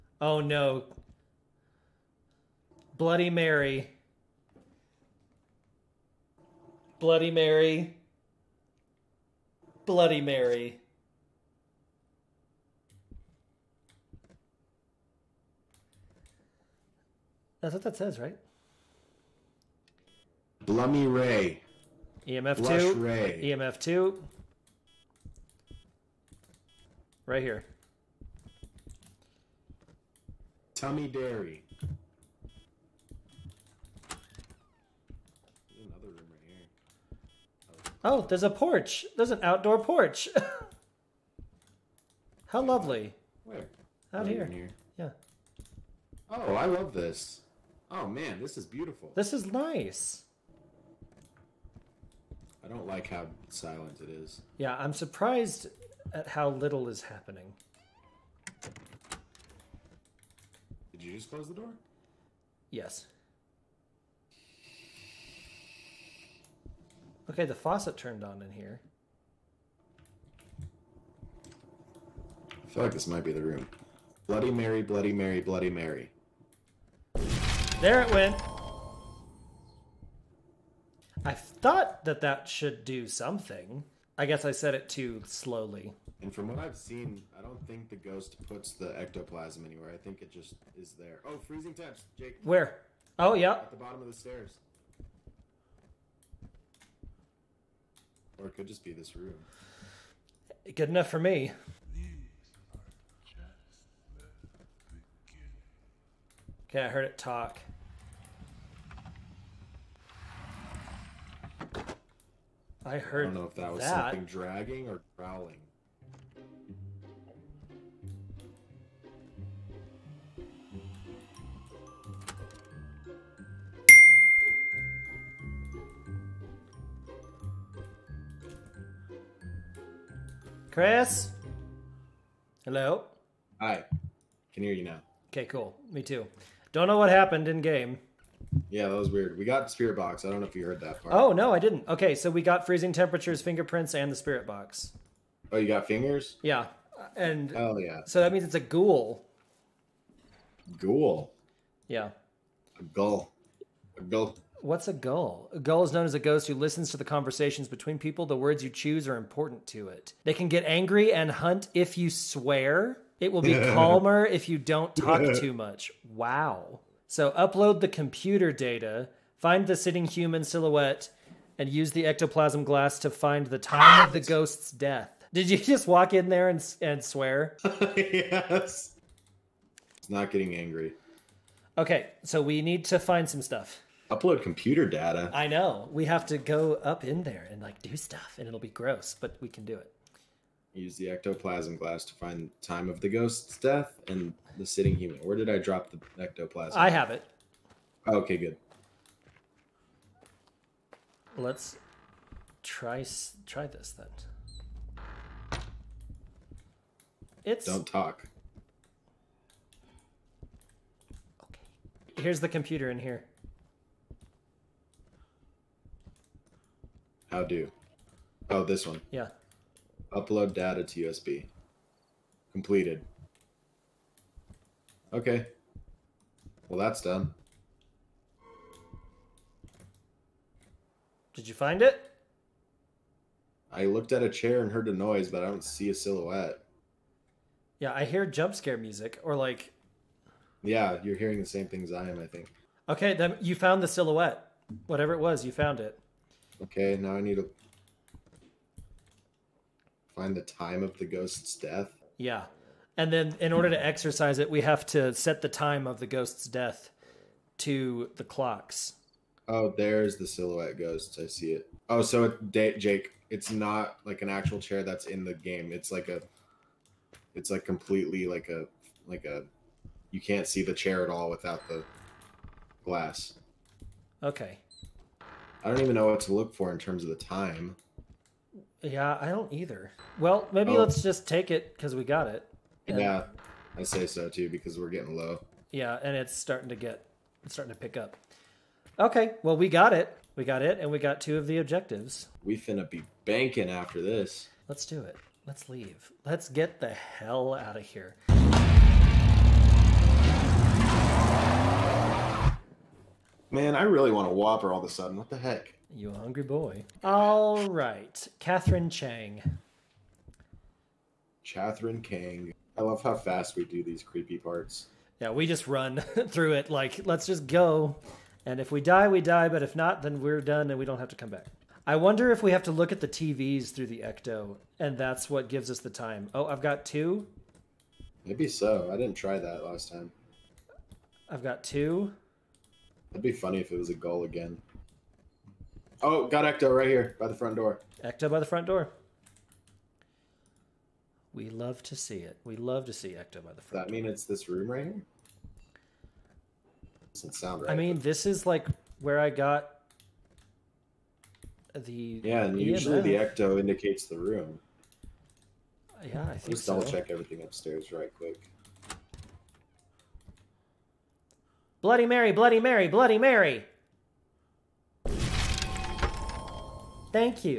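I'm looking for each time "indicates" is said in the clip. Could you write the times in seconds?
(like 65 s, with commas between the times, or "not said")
353 s.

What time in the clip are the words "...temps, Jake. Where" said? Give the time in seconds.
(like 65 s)
91 s.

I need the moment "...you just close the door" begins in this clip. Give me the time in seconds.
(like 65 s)
61 s.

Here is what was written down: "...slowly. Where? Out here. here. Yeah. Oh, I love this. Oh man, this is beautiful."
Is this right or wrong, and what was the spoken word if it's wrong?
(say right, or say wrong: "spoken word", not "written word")
wrong: "lovely", not "slowly".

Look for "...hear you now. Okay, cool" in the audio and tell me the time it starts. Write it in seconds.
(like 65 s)
134 s.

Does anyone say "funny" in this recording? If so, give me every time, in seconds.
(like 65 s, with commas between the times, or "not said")
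333 s.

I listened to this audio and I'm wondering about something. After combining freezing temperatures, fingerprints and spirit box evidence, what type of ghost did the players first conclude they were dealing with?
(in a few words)
Ghoul.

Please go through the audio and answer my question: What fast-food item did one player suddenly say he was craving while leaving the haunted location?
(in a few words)
Whopper.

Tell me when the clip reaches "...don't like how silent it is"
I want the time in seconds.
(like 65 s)
52 s.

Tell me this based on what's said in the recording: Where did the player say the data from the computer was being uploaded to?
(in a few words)
USB.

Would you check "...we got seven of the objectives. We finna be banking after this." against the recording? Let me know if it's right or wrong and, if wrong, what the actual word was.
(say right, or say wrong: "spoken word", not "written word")
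wrong: "two", not "seven".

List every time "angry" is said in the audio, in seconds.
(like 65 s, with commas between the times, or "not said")
160 s, 180 s.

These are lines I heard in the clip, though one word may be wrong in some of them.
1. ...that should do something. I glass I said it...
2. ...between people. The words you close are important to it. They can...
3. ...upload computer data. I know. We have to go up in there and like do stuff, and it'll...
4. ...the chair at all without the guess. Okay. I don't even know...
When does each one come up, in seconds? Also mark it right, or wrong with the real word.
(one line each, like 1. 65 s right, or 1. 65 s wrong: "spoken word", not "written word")
1. 82 s wrong: "guess", not "glass"
2. 157 s wrong: "choose", not "close"
3. 184 s right
4. 270 s wrong: "glass", not "guess".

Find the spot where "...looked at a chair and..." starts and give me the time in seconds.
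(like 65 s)
233 s.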